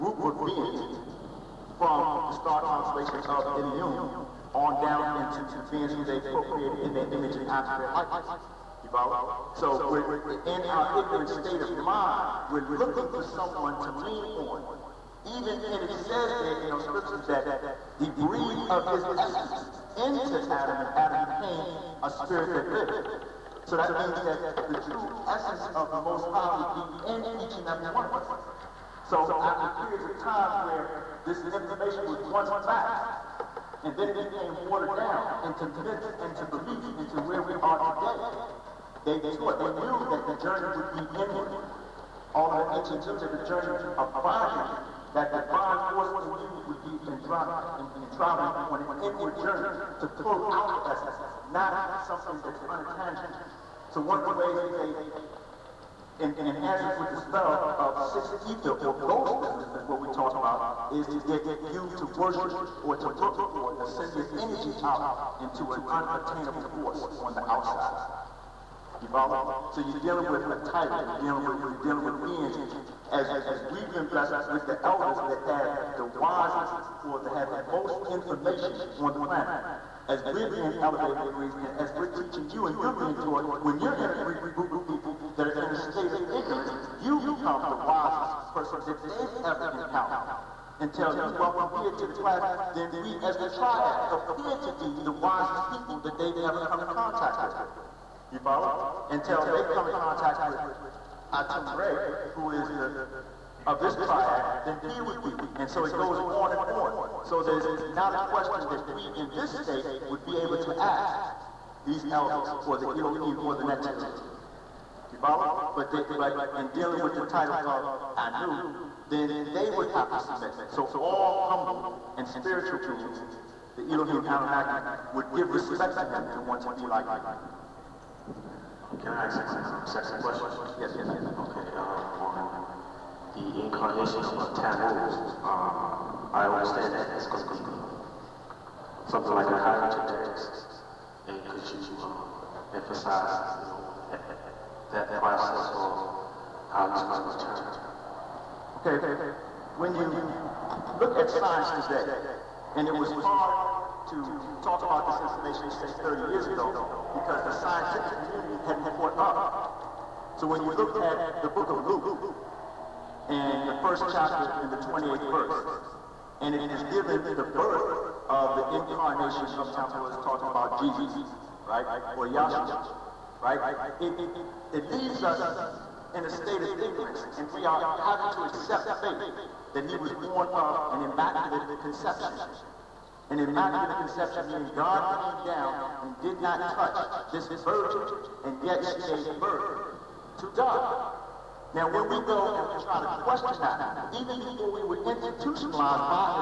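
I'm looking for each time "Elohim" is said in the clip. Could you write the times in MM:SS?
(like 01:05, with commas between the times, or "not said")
01:52, 02:03.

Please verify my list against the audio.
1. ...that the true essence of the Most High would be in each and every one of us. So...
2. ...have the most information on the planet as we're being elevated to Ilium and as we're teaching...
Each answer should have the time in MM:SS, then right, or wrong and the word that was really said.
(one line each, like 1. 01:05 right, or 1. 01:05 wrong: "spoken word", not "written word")
1. 00:24 right
2. 01:17 wrong: "Greece", not "Ilium".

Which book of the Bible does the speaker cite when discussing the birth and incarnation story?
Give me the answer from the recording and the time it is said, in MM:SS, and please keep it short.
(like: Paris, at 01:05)
Luke, at 02:41.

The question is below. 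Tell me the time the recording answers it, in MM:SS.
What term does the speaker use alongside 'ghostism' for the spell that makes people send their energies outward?
00:58.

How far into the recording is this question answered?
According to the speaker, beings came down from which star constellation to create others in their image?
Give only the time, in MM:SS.
00:03.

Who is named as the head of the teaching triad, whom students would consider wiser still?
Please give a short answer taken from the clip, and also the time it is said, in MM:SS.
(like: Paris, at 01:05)
Atum Re, at 01:41.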